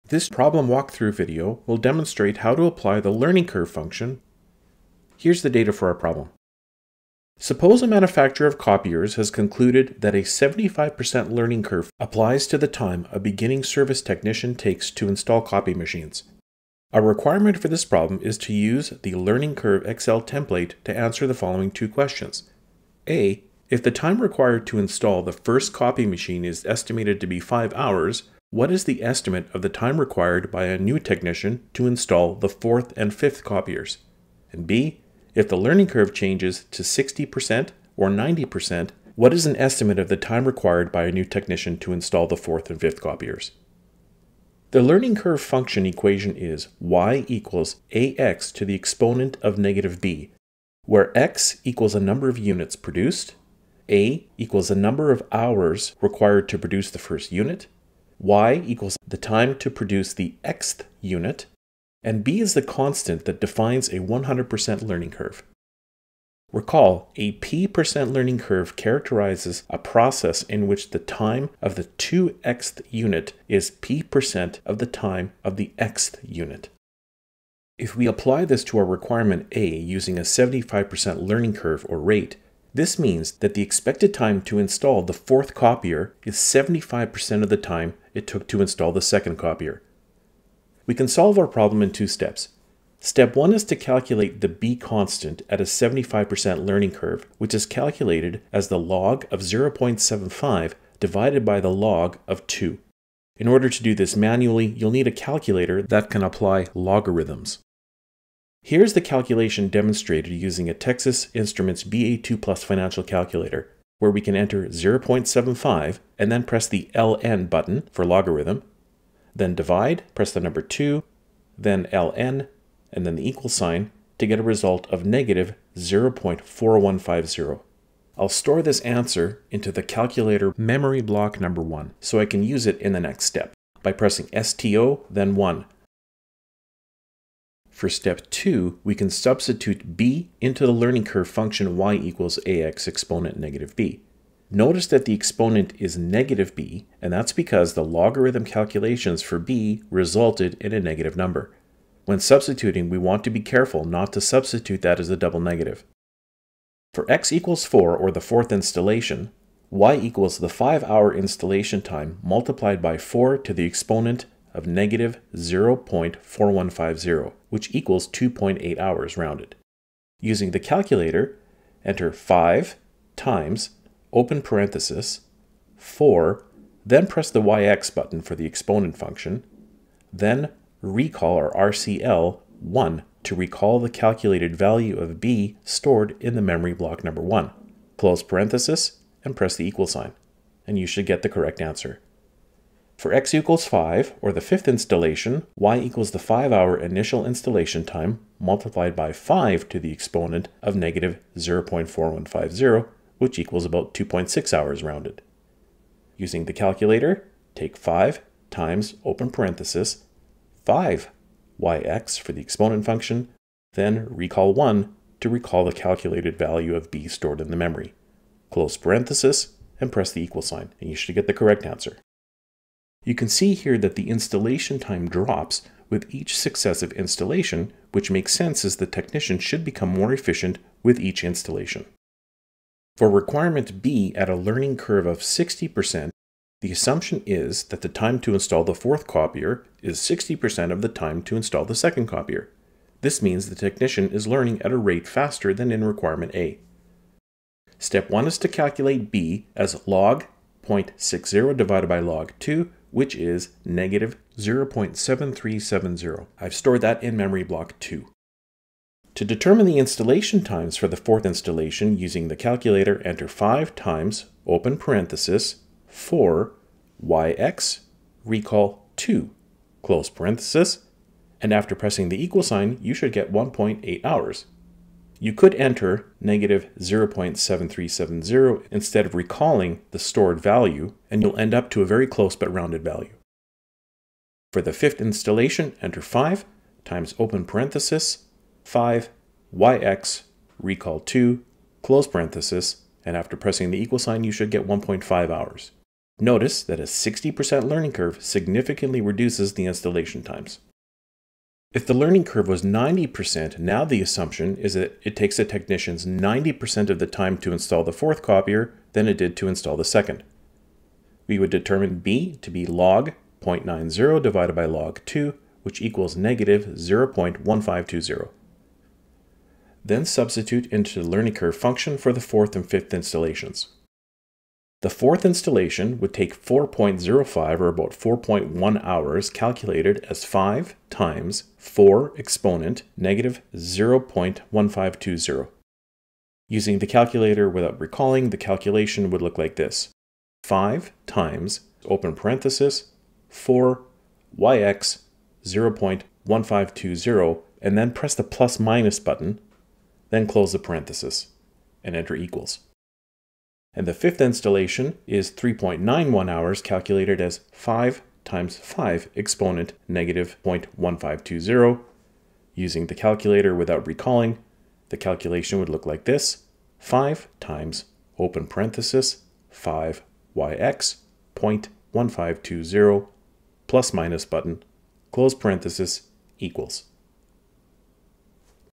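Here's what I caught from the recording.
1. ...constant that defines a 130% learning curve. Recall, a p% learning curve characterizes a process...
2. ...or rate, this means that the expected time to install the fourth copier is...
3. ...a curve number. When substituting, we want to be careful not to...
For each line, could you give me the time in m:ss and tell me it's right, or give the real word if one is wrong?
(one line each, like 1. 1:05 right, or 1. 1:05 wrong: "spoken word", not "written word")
1. 1:02 wrong: "100", not "130"
2. 1:21 right
3. 2:30 wrong: "negative", not "curve".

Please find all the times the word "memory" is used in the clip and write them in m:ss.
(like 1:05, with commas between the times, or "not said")
2:10, 3:06, 3:37, 4:17.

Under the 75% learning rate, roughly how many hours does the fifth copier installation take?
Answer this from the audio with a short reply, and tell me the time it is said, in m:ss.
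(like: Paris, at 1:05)
2.6 hours, at 3:23.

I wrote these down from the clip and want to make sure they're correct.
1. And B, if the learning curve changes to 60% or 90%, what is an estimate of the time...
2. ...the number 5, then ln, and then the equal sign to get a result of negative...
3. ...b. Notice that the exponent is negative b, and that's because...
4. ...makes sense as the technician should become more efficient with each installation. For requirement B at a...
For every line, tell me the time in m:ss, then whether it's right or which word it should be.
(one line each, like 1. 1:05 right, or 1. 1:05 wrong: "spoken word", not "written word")
1. 0:34 right
2. 2:00 wrong: "2", not "5"
3. 2:23 right
4. 3:48 right.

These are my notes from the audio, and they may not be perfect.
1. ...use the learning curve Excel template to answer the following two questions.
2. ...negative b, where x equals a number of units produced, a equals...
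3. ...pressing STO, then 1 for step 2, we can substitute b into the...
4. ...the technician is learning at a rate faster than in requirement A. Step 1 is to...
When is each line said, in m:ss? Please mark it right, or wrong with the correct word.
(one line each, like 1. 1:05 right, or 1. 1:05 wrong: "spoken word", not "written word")
1. 0:18 right
2. 0:49 right
3. 2:13 right
4. 4:03 right.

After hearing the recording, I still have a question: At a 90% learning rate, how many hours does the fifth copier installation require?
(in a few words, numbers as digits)
3.91 hours.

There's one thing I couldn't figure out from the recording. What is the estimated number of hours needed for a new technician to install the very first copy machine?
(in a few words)
5 hours.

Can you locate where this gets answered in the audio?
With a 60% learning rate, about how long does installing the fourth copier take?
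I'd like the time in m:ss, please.
4:33.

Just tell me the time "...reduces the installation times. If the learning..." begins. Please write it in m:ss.
4:59.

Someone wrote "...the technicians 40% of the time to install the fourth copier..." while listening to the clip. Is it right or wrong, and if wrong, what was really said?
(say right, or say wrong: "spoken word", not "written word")
wrong: "90", not "40".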